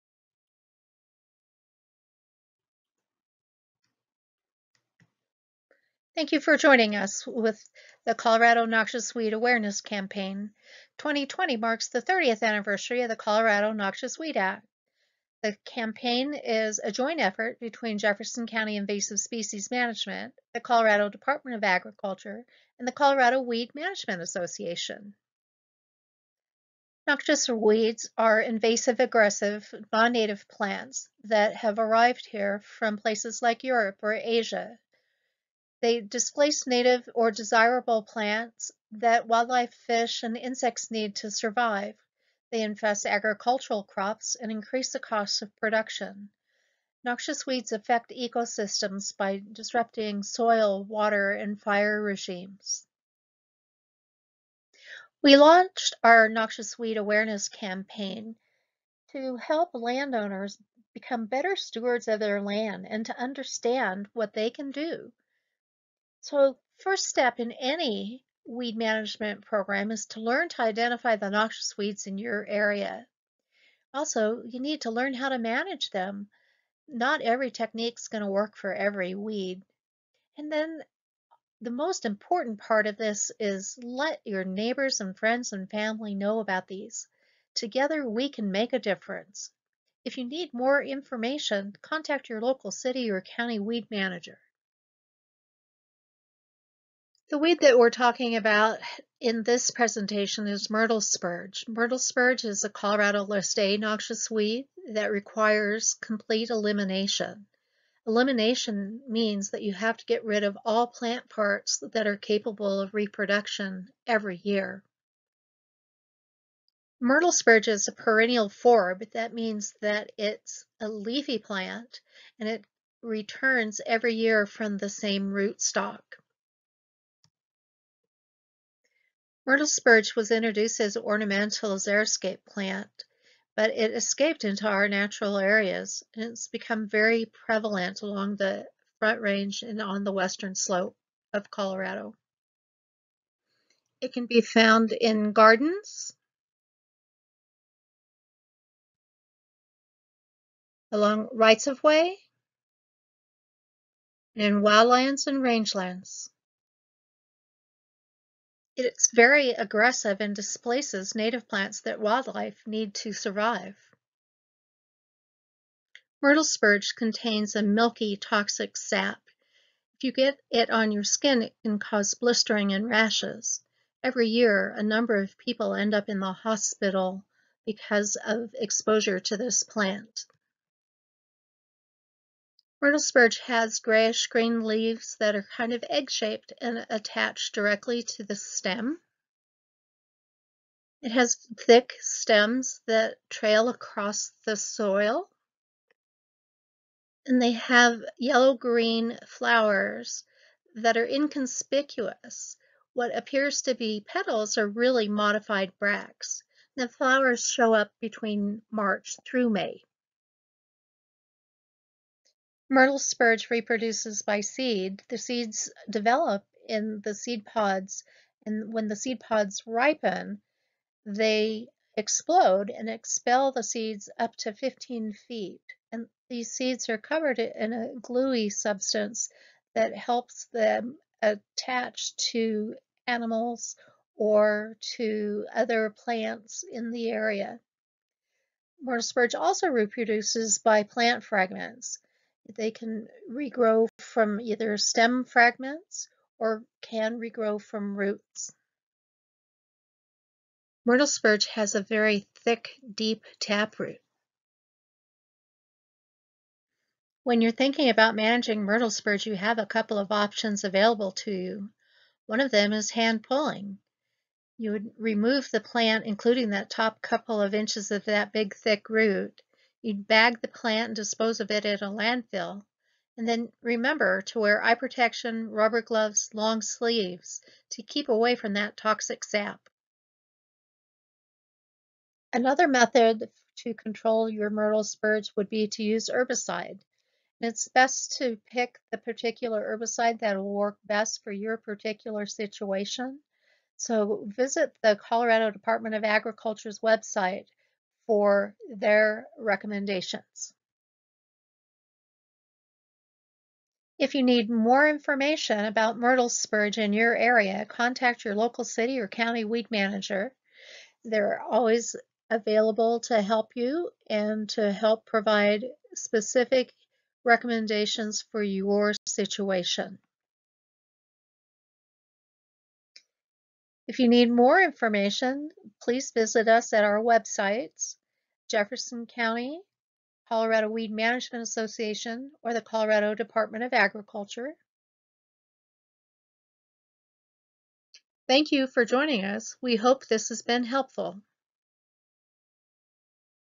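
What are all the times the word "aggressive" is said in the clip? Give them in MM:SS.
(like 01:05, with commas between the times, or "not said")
00:28, 02:39.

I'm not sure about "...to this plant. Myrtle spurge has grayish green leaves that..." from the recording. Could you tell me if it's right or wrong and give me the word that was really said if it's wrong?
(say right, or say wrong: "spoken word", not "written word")
right.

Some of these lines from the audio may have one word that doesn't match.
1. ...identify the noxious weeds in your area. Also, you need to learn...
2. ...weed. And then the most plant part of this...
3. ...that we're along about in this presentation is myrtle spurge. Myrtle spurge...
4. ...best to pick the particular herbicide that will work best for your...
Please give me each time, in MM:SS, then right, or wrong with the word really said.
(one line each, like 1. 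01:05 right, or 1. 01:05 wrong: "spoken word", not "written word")
1. 01:10 right
2. 01:19 wrong: "important", not "plant"
3. 01:37 wrong: "talking", not "along"
4. 04:47 right.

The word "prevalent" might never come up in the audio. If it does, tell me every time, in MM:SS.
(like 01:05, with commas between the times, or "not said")
02:17.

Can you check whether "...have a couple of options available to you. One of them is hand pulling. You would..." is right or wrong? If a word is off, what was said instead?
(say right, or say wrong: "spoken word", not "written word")
right.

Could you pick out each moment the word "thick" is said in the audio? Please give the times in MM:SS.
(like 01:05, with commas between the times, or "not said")
03:11, 04:12, 04:28.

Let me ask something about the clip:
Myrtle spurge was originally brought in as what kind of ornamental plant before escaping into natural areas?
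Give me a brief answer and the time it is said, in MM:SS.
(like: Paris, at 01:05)
xeriscape plant, at 02:11.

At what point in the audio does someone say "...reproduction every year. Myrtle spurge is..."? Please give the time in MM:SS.
01:52.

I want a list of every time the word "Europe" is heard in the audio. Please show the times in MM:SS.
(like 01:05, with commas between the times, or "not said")
00:33.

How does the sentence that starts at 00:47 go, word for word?
Noxious weeds affect ecosystems by disrupting soil, water, and fire regimes.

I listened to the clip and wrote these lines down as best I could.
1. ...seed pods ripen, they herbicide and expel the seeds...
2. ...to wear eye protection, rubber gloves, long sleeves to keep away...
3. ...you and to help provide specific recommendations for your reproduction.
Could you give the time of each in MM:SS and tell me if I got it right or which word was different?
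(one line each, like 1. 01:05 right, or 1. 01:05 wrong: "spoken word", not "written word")
1. 03:38 wrong: "explode", not "herbicide"
2. 04:34 right
3. 05:13 wrong: "situation", not "reproduction".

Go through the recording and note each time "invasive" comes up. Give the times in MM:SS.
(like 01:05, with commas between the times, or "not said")
00:18, 00:28.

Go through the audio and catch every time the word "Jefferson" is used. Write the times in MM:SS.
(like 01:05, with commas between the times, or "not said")
00:17, 05:28.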